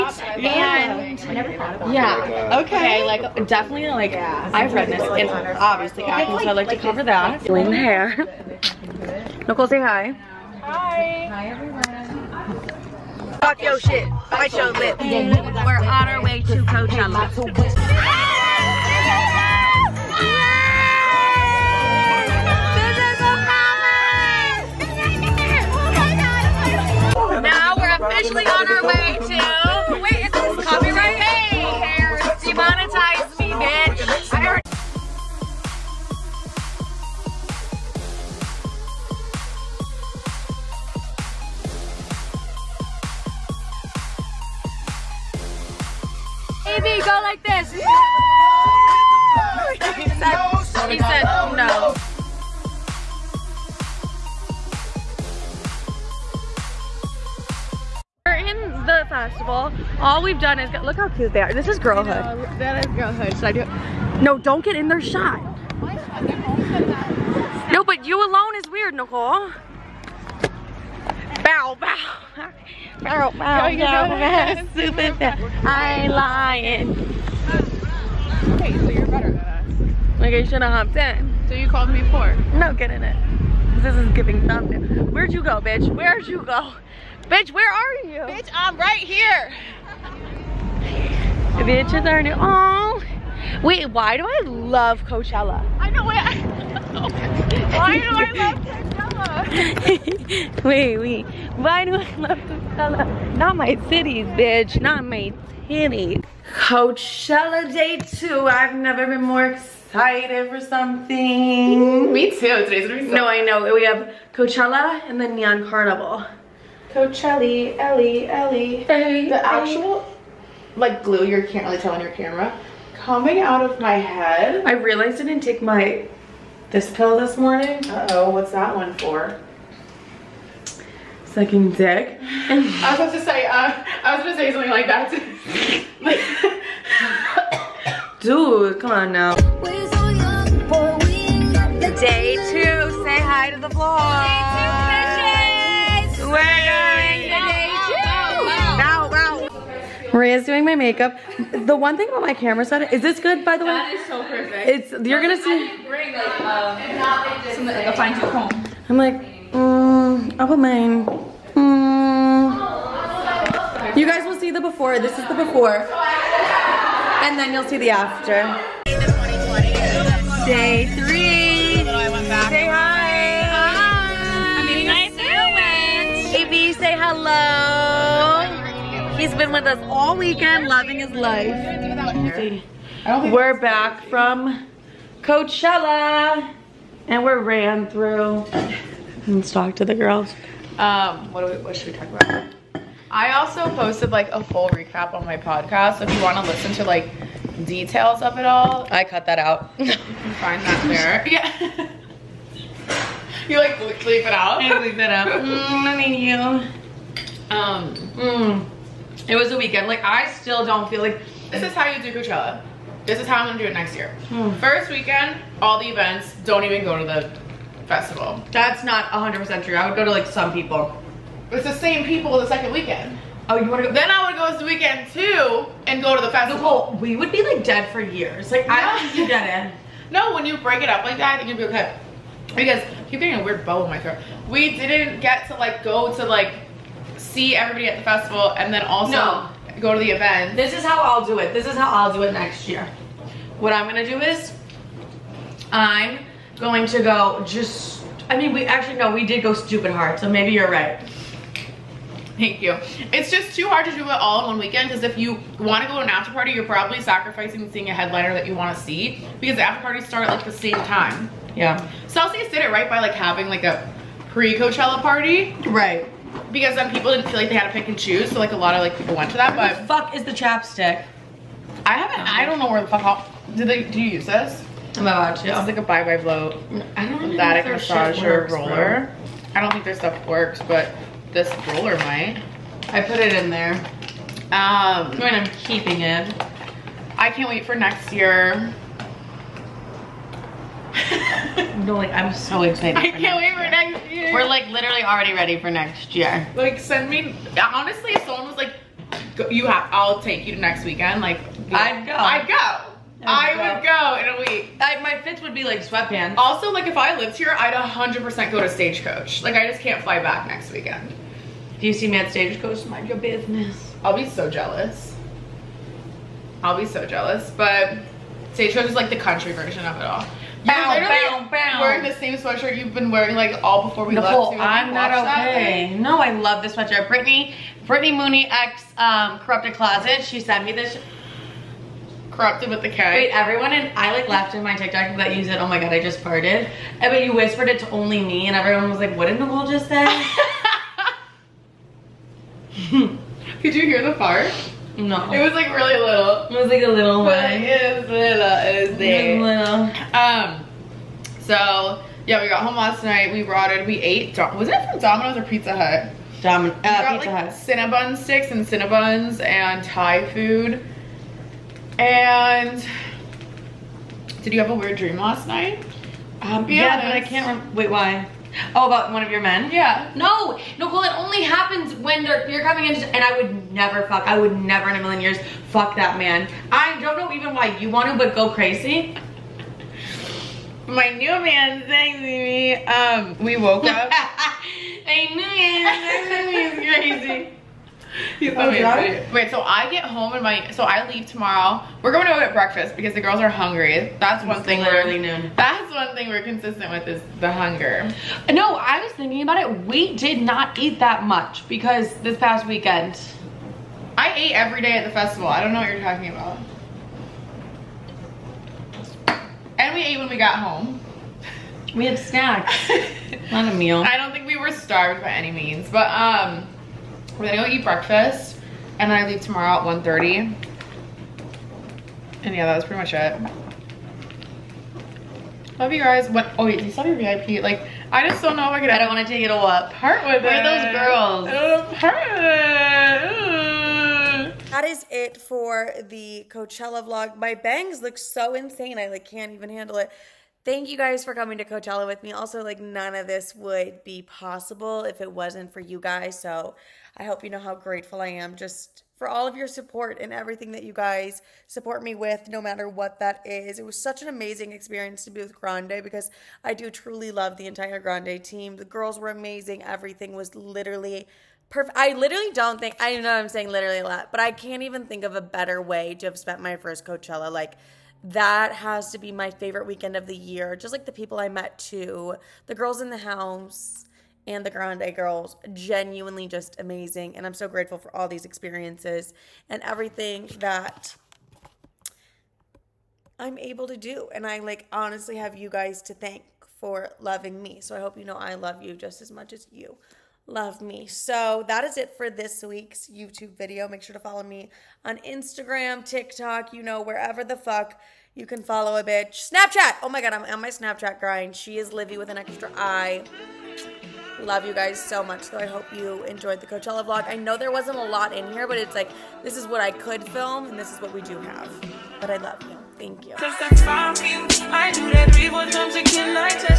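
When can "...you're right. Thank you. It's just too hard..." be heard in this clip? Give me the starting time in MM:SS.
04:10.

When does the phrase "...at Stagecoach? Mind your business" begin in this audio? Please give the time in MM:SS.
05:12.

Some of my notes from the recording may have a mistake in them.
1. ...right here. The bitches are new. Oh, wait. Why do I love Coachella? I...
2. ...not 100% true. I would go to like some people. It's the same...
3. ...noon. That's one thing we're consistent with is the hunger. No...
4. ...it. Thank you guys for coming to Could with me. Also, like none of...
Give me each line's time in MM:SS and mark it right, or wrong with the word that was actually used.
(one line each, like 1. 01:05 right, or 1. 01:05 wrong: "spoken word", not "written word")
1. 01:28 right
2. 03:38 right
3. 06:35 right
4. 07:19 wrong: "Coachella", not "Could".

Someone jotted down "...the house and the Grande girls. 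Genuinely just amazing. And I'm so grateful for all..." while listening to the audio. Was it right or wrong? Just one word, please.
right.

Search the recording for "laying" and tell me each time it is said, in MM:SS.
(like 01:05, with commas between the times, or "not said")
not said.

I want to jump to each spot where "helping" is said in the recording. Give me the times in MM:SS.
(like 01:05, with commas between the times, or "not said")
not said.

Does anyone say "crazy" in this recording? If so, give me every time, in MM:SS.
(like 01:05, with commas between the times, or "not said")
06:18, 06:27.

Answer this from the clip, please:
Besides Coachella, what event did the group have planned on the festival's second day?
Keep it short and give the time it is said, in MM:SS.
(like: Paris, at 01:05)
Neon Carnival, at 01:55.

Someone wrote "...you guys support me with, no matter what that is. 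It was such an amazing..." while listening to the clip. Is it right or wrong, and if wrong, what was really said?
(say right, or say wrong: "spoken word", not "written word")
right.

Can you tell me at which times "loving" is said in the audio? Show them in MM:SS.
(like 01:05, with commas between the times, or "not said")
03:00, 08:07.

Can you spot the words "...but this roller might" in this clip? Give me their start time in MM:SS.
04:40.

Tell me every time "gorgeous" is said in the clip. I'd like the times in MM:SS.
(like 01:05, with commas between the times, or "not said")
not said.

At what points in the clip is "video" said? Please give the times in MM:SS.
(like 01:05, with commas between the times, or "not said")
08:13.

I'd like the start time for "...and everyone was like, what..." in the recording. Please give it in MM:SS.
05:38.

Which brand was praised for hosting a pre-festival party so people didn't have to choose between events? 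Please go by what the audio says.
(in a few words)
Celsius.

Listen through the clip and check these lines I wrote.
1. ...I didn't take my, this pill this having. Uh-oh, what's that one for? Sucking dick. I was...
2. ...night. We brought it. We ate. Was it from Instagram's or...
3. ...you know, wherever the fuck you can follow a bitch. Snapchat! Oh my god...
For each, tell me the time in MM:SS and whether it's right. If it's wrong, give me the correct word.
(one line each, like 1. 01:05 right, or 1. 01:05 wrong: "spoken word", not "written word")
1. 02:05 wrong: "morning", not "having"
2. 05:53 wrong: "Domino", not "Instagram"
3. 08:16 right.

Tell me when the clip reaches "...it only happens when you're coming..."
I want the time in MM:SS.
06:11.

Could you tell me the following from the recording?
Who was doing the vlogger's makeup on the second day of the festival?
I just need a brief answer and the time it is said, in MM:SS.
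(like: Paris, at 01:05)
Maria, at 02:30.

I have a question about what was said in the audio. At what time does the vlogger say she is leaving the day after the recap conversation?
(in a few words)
1:30.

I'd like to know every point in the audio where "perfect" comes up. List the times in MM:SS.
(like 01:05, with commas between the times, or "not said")
02:34, 07:41.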